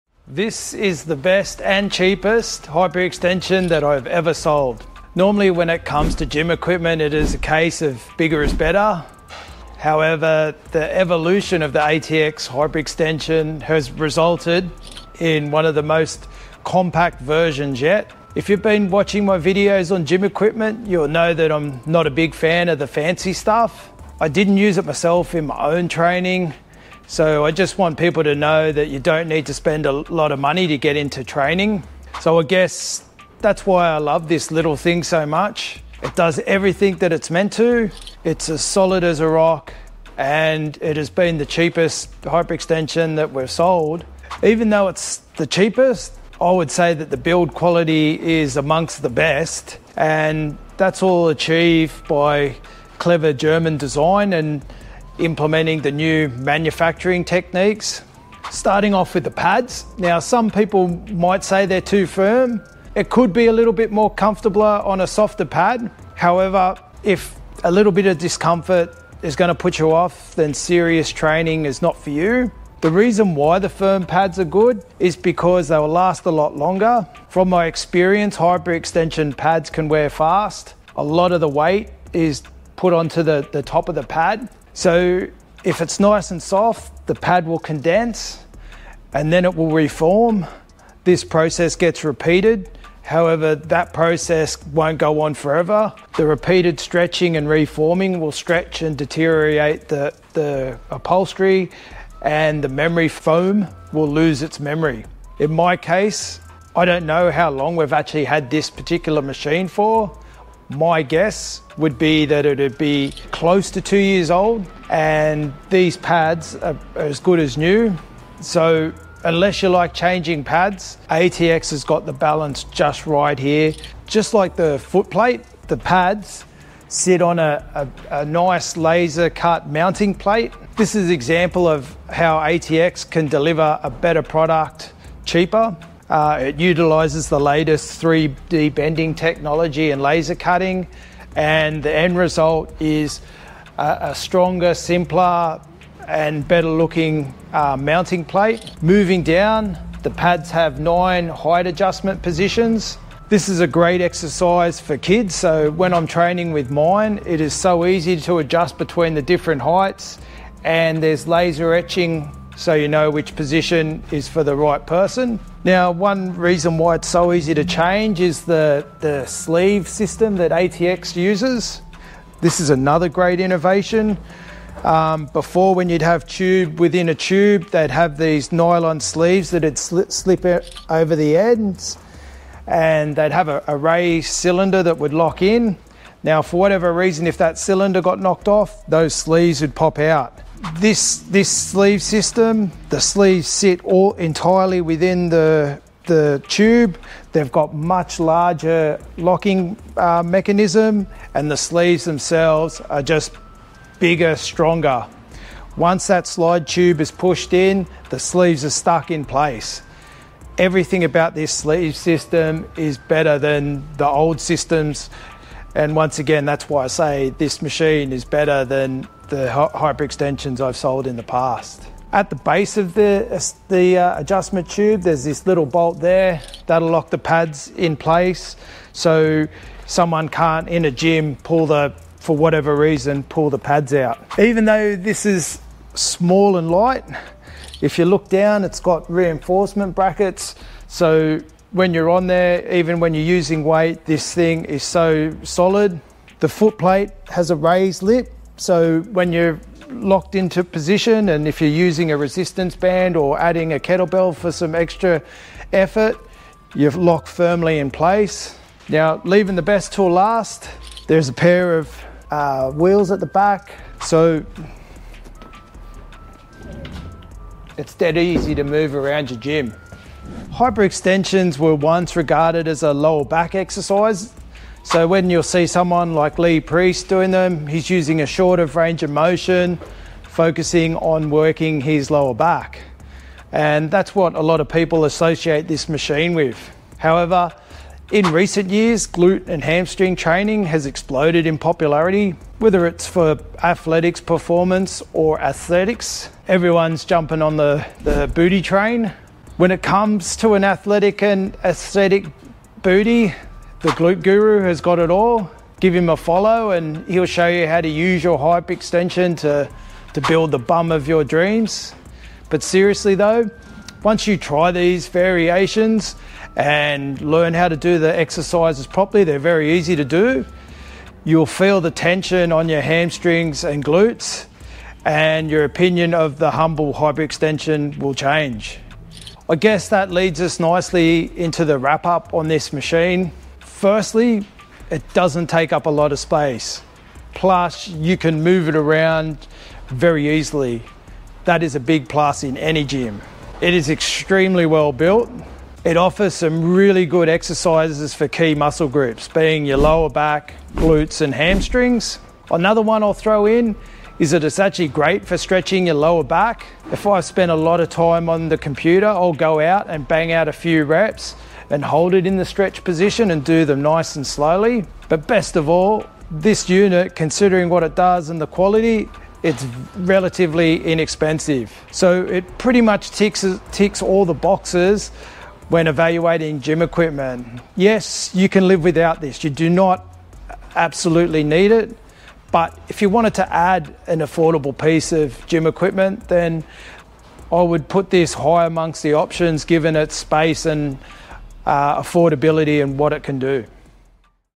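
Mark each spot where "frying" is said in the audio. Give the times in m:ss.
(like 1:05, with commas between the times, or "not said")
not said.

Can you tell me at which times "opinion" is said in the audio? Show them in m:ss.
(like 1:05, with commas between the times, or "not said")
5:25.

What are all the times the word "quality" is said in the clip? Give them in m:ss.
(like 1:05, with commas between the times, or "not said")
0:47, 6:08.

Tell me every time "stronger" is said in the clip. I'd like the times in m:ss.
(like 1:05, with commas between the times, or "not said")
2:24, 3:24.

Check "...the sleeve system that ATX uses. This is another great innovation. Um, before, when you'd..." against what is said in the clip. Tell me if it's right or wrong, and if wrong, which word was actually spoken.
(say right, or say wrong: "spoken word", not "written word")
right.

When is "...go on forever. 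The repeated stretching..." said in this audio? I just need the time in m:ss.
1:34.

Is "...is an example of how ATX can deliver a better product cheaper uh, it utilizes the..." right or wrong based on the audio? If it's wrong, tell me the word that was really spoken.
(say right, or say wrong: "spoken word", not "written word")
right.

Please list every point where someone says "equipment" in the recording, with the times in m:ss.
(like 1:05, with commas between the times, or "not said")
0:06, 0:20, 6:16, 6:25.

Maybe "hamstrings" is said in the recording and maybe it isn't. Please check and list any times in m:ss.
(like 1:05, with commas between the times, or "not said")
4:49, 5:22, 5:51.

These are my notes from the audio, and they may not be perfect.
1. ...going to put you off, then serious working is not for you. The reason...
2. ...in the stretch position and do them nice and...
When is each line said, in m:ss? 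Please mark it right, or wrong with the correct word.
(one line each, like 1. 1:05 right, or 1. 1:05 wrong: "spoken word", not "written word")
1. 1:09 wrong: "training", not "working"
2. 6:02 right.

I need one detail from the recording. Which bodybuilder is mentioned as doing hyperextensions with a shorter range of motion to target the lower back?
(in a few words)
Lee Priest.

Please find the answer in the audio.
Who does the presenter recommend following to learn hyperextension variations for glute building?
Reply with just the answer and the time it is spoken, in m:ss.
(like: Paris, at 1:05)
the Glute Guru, at 5:03.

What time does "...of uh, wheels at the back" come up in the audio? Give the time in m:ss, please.
4:21.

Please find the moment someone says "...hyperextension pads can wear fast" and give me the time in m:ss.
1:18.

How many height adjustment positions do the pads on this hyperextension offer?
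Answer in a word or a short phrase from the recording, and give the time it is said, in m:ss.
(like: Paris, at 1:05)
9, at 2:30.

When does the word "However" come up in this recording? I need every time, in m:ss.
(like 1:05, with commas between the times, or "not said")
0:09, 1:06, 1:33, 4:46.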